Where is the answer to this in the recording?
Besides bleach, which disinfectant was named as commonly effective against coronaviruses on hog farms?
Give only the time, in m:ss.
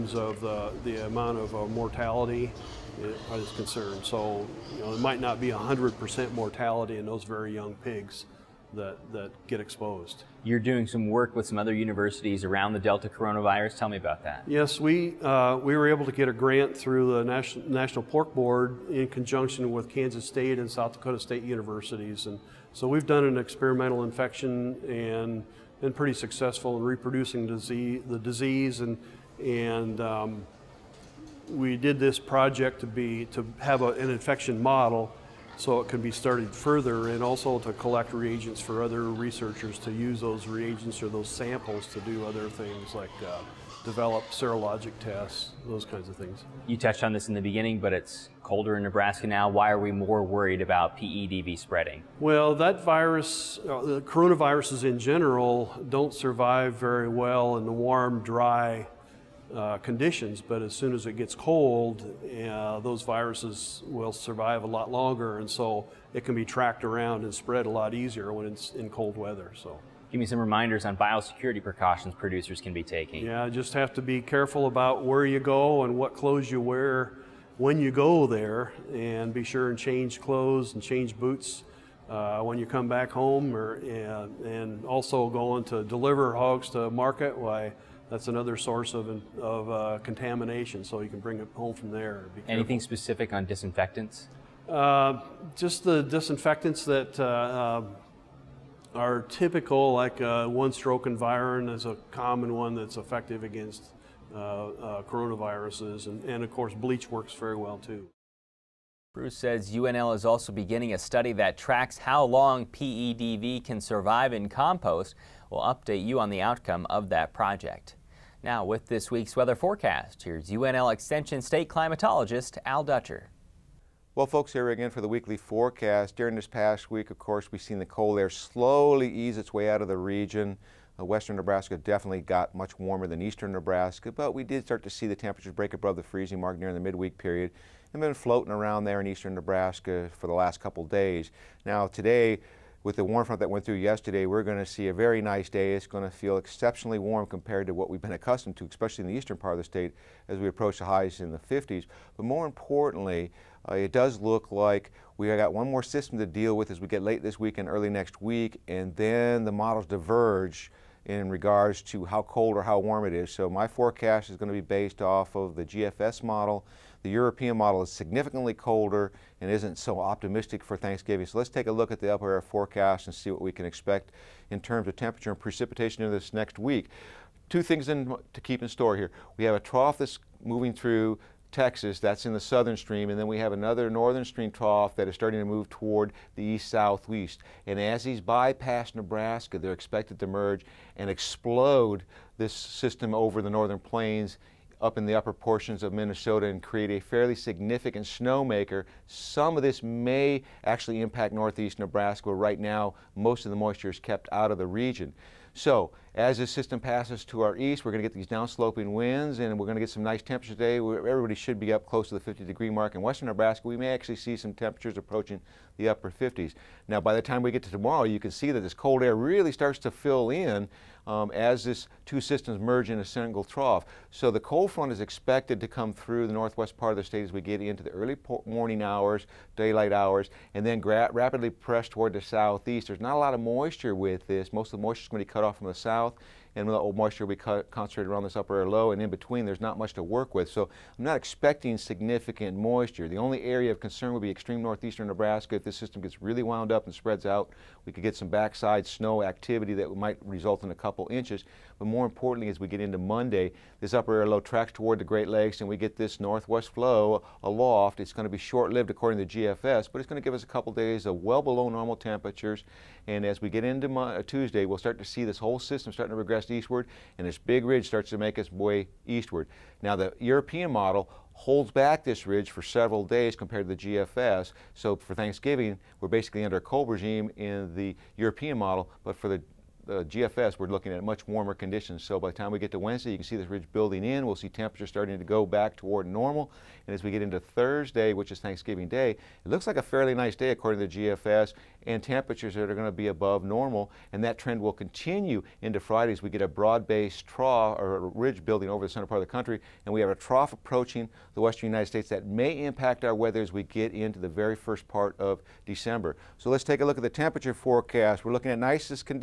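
1:40.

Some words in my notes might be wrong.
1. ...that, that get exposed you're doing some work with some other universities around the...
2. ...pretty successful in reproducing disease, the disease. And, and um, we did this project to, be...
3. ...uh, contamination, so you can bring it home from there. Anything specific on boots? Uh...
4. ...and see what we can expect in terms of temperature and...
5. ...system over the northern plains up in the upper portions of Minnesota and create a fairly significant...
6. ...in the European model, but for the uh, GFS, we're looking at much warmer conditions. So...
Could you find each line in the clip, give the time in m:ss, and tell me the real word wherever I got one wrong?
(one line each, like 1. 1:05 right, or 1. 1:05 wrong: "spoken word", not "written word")
1. 0:08 right
2. 0:25 right
3. 1:29 wrong: "disinfectants", not "boots"
4. 2:53 right
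5. 3:12 right
6. 4:37 right.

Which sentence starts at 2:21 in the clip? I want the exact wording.
Now, today, with the warm front that went through yesterday, we're going to see a very nice day.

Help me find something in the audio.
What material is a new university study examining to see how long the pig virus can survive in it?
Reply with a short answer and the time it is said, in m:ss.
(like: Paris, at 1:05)
Compost, at 1:54.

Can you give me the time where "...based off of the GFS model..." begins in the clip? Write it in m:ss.
2:44.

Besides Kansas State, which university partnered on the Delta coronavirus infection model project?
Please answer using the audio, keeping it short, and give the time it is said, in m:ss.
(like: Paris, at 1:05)
South Dakota State, at 0:20.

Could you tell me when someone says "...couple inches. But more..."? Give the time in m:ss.
4:10.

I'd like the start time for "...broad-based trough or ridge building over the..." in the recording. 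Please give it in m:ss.
4:56.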